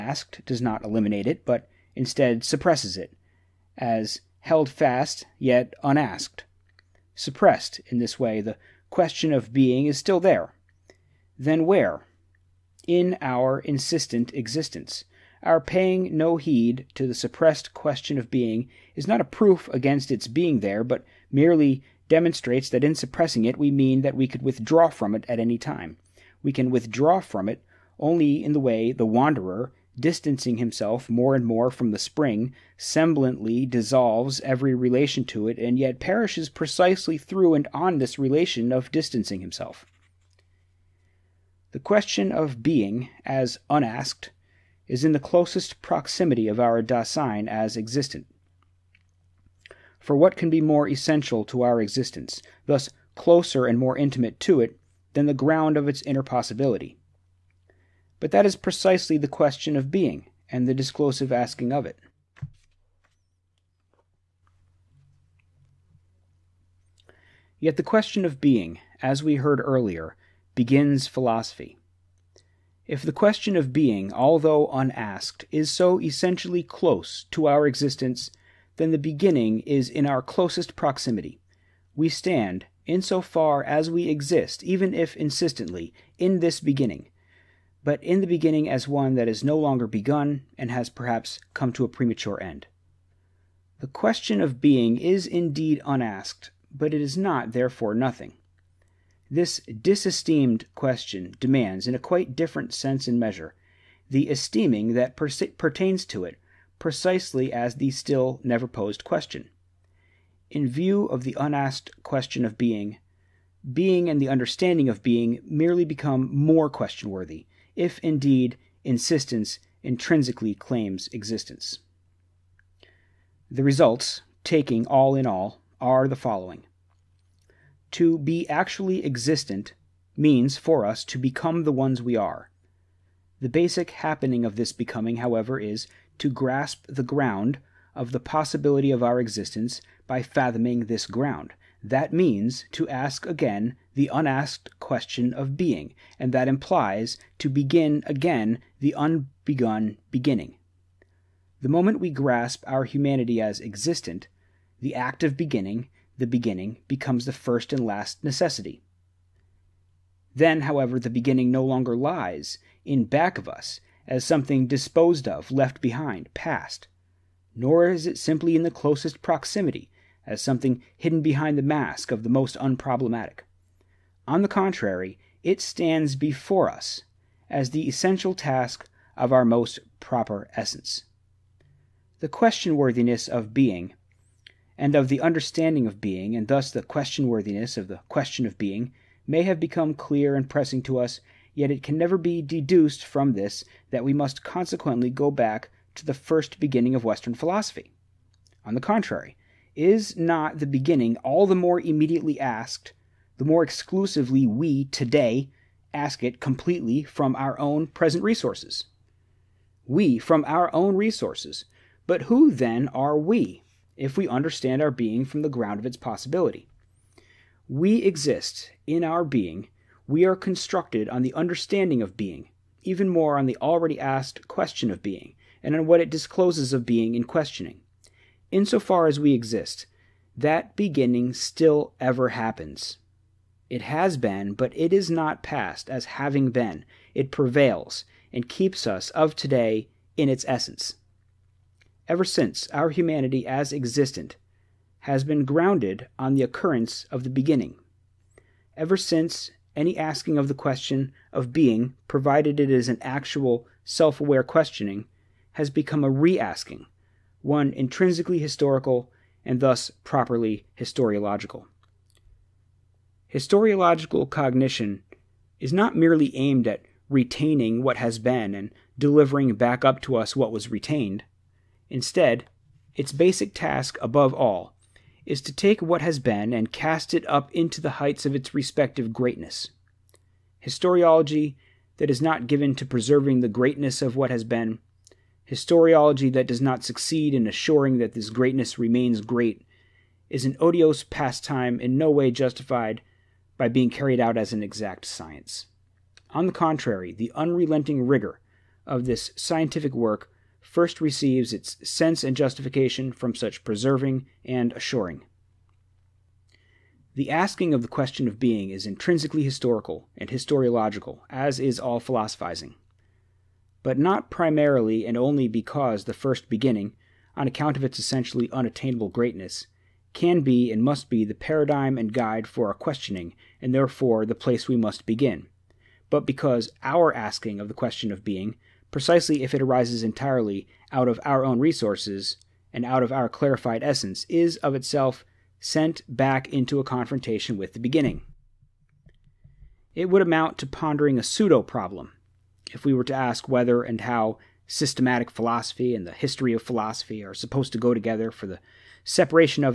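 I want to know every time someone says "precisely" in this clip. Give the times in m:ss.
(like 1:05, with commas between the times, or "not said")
0:36, 0:58, 1:46, 5:28.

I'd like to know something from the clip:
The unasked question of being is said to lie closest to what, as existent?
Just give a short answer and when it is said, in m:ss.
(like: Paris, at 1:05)
our Dasein, at 0:46.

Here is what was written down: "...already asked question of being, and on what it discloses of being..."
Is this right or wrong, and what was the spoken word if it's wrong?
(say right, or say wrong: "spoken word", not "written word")
right.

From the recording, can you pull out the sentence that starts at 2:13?
The basic happening of this becoming, however, is to grasp the ground of the possibility of our existence by fathoming this ground.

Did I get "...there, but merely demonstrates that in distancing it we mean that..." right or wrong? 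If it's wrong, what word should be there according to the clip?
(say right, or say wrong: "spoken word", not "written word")
wrong: "suppressing", not "distancing".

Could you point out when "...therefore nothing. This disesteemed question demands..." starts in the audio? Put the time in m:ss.
1:37.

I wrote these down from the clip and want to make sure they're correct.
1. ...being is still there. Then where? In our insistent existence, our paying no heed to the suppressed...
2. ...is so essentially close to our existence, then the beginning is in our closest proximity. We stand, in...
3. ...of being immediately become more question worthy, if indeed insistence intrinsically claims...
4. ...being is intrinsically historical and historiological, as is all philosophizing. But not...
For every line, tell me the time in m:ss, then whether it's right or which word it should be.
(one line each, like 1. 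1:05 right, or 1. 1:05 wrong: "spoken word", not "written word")
1. 0:09 right
2. 1:15 right
3. 1:54 wrong: "merely", not "immediately"
4. 5:08 right.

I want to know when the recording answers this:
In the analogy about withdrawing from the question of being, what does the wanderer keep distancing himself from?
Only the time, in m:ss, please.
0:31.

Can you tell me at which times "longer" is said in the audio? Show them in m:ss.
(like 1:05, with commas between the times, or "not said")
1:29, 2:41.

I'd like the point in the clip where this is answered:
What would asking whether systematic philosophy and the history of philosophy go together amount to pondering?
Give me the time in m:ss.
5:41.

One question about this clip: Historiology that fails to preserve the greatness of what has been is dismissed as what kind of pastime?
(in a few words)
an odious pastime.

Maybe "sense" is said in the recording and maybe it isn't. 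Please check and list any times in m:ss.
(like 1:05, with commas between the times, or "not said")
1:42, 5:01.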